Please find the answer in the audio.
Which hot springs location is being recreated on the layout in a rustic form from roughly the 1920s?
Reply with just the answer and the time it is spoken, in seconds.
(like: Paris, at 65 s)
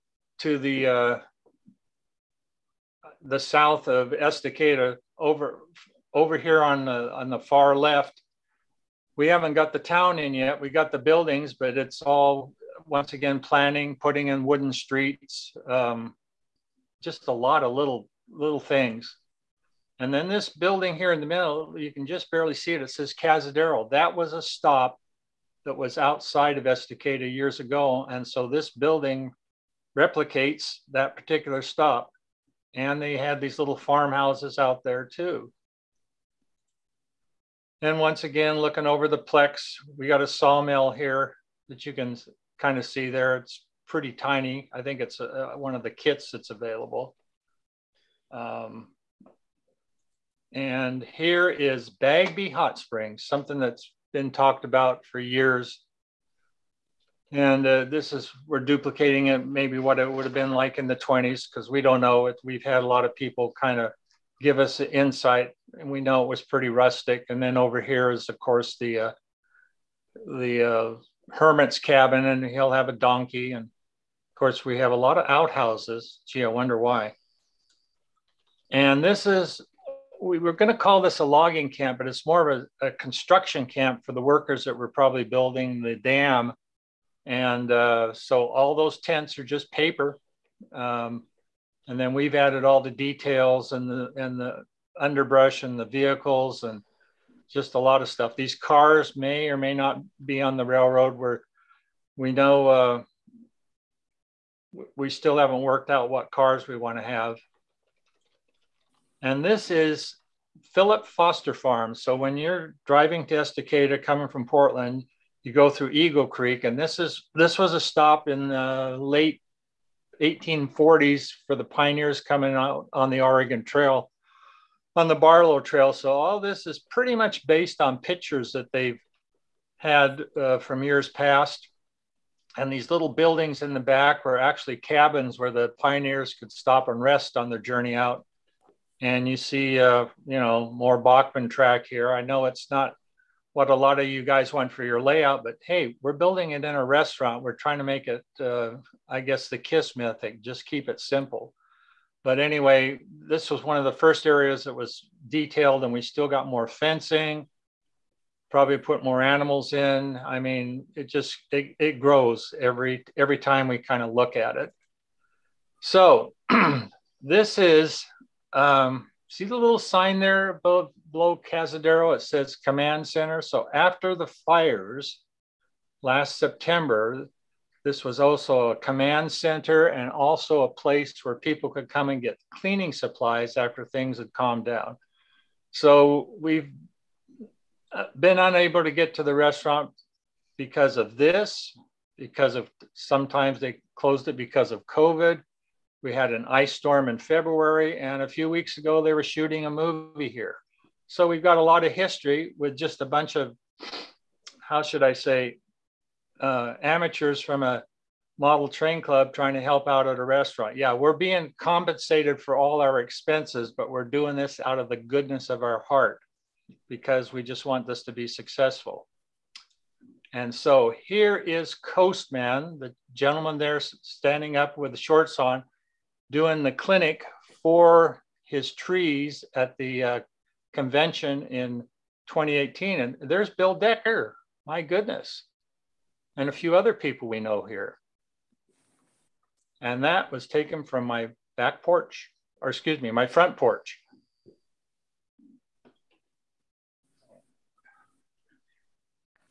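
Bagby Hot Springs, at 51 s.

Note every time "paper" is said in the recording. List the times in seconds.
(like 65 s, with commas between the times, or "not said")
89 s.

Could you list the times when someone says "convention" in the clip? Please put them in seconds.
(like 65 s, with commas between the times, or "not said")
230 s.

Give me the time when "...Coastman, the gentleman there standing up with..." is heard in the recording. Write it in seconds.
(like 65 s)
221 s.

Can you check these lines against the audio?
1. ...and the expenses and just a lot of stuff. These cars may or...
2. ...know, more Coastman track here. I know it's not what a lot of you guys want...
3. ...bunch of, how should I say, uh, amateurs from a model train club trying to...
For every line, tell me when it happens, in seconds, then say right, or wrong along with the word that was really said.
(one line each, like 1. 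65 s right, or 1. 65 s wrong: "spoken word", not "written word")
1. 95 s wrong: "vehicles", not "expenses"
2. 140 s wrong: "Bachmann", not "Coastman"
3. 203 s right.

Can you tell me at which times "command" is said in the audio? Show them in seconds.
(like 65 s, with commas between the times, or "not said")
172 s, 178 s.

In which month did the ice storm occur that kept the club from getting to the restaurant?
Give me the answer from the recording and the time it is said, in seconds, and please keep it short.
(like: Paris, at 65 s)
February, at 197 s.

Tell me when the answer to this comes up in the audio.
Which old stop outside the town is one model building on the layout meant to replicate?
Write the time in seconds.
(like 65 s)
23 s.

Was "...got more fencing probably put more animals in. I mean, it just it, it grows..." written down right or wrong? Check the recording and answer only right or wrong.
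right.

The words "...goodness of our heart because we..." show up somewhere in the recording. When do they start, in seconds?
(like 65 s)
214 s.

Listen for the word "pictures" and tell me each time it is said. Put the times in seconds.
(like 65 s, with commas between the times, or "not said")
127 s.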